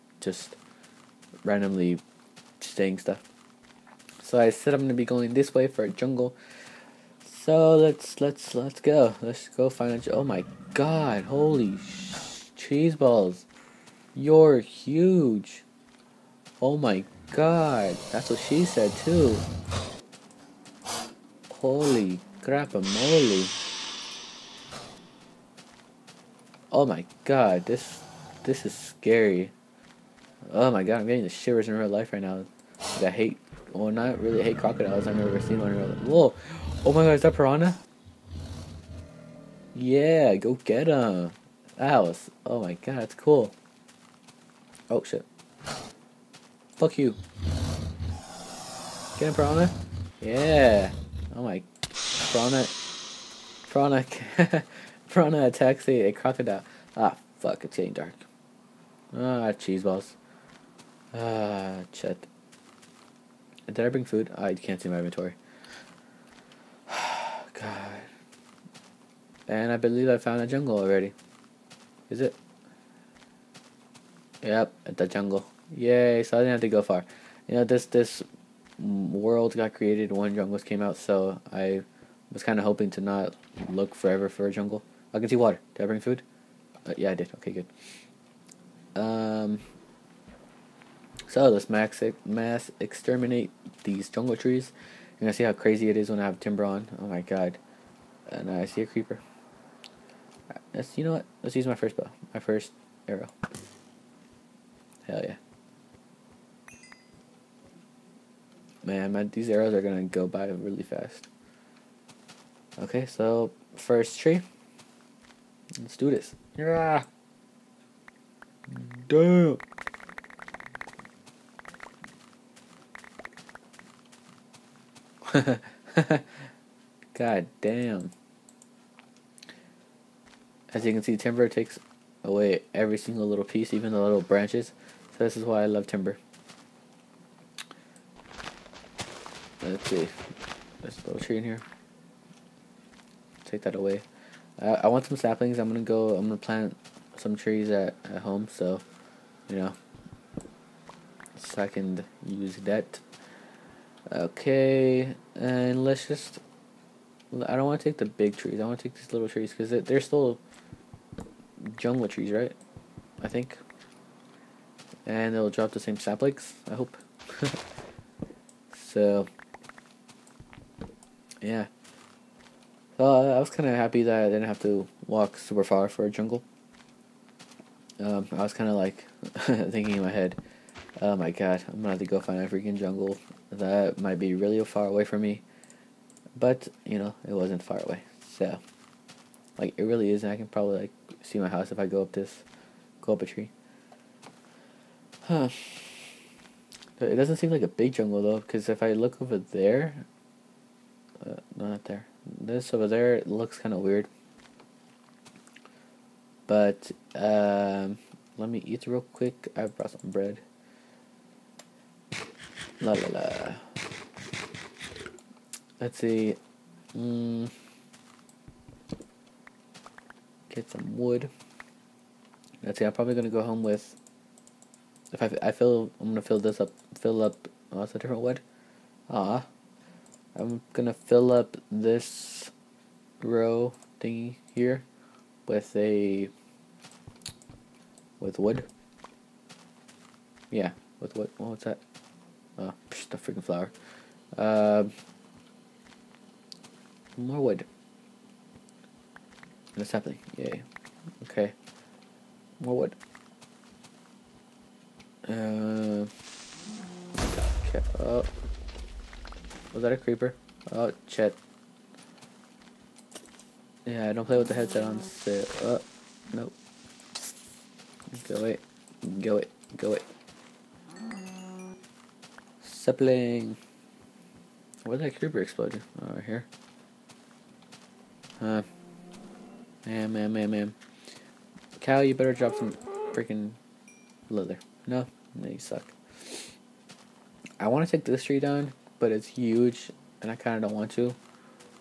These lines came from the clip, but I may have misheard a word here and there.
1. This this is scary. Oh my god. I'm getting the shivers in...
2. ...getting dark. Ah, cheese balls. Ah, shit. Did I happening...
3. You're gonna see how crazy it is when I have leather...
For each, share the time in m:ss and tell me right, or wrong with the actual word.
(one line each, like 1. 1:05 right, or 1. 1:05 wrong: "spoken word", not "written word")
1. 0:27 right
2. 0:57 wrong: "bring", not "happening"
3. 1:35 wrong: "timber", not "leather".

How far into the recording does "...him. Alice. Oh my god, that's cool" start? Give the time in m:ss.
0:40.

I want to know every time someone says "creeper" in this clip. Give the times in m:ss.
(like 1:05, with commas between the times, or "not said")
1:38, 4:19, 4:35.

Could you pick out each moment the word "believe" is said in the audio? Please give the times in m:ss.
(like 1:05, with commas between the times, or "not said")
1:09.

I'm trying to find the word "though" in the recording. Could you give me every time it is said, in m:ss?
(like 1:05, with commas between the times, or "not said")
3:18.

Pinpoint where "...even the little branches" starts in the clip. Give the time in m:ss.
2:13.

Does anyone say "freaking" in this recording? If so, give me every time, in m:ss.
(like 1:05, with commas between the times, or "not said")
3:02, 4:03, 4:43.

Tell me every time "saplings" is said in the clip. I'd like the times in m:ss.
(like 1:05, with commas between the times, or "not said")
2:25, 2:45, 4:32.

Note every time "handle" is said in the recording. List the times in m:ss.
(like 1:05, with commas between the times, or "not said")
not said.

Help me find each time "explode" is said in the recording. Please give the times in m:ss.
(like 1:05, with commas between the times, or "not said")
4:35.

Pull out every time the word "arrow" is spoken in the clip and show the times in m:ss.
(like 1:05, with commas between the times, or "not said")
1:43, 1:49.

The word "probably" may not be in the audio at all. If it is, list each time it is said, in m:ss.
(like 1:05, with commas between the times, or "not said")
3:10, 3:42.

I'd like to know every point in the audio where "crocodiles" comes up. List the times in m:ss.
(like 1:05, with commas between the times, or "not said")
0:34, 0:56.